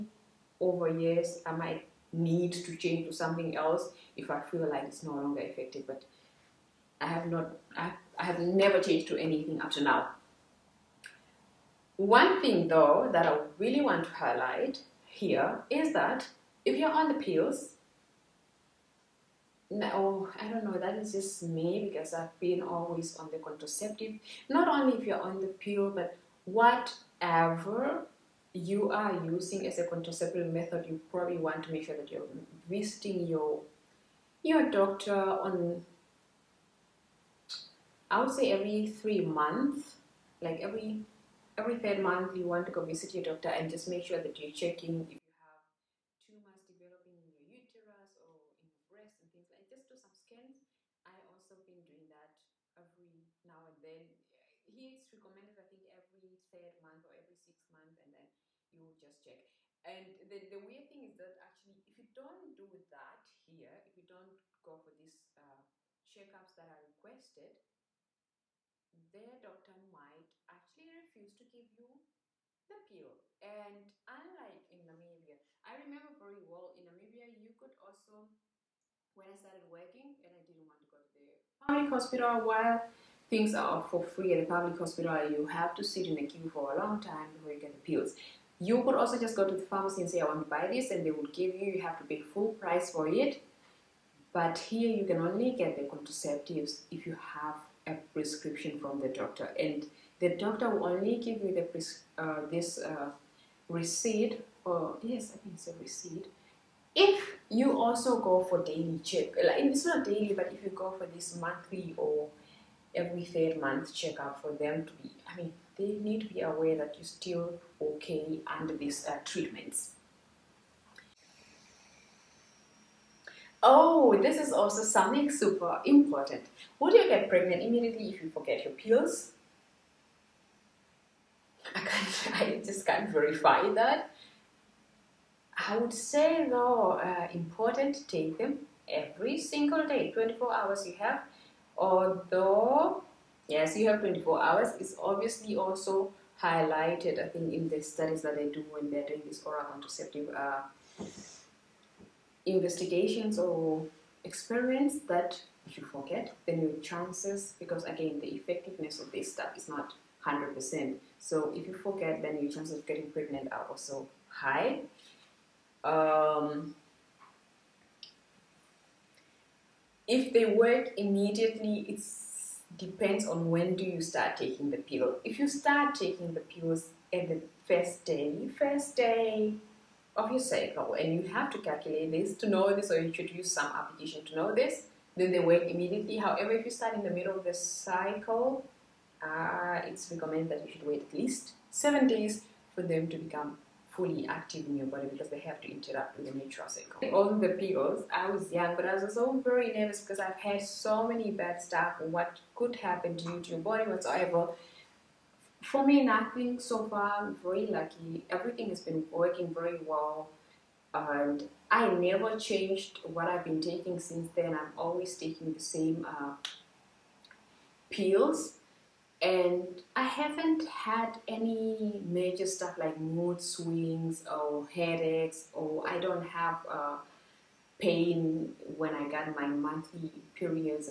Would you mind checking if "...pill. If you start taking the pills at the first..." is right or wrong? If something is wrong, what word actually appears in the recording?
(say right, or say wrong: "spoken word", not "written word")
right.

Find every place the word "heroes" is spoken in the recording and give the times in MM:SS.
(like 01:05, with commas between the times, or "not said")
not said.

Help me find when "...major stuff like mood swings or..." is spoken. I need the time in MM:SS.
03:42.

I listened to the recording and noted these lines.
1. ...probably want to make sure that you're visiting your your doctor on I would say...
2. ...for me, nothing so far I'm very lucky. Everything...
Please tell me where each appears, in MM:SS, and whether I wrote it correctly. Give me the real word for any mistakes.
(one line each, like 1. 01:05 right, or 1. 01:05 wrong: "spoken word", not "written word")
1. 00:31 right
2. 03:25 right.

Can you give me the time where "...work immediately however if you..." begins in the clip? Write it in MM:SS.
03:05.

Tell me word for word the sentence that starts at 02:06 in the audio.
Would you get pregnant immediately if you forget your pills?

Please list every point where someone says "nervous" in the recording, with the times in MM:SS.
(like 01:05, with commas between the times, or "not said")
03:19.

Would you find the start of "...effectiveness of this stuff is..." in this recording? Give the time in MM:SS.
02:38.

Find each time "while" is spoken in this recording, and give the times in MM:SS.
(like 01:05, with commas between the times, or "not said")
01:22.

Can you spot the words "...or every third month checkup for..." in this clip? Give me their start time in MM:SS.
01:51.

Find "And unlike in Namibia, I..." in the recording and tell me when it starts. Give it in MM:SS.
01:13.